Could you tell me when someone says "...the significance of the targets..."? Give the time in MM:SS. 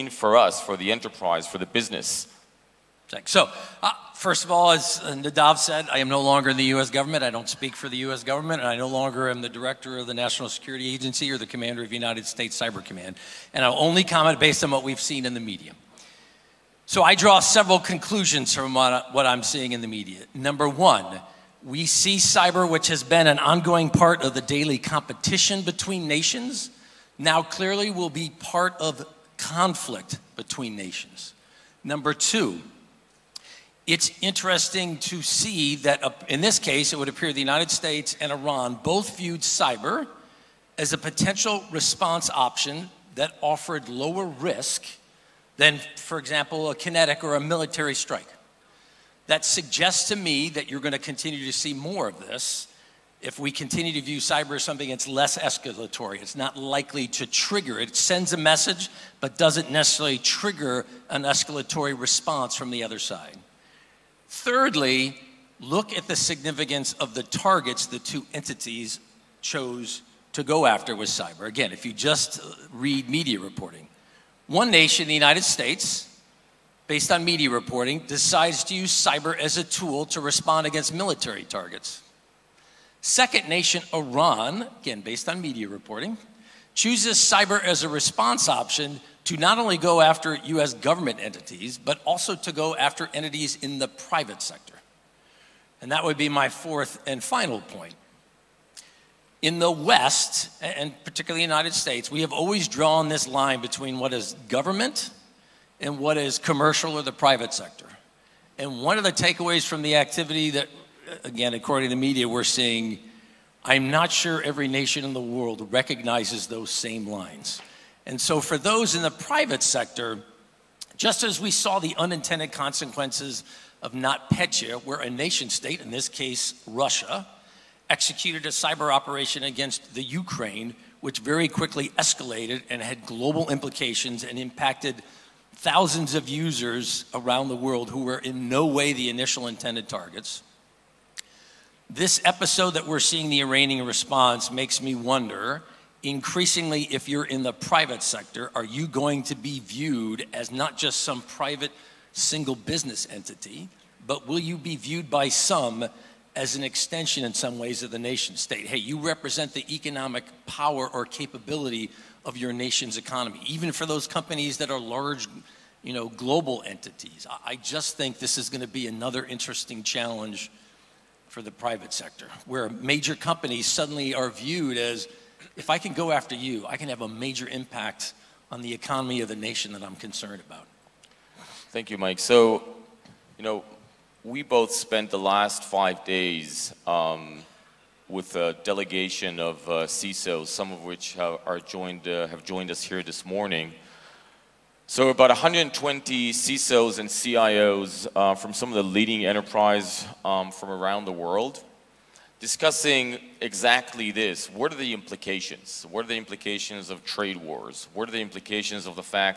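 01:06.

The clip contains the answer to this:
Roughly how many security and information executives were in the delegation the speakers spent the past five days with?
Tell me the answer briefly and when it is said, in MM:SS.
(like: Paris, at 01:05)
120, at 03:15.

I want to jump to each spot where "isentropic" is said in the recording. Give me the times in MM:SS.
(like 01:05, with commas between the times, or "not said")
not said.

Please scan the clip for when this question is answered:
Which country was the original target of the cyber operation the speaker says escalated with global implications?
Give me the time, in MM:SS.
02:09.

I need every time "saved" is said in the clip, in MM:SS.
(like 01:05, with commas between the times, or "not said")
not said.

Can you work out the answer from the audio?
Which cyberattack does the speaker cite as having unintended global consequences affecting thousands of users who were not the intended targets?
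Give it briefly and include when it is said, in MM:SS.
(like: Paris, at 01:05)
NotPetya, at 02:03.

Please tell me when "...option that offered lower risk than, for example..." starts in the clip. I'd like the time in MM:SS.
00:42.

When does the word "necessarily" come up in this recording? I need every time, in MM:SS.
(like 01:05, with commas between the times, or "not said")
00:59.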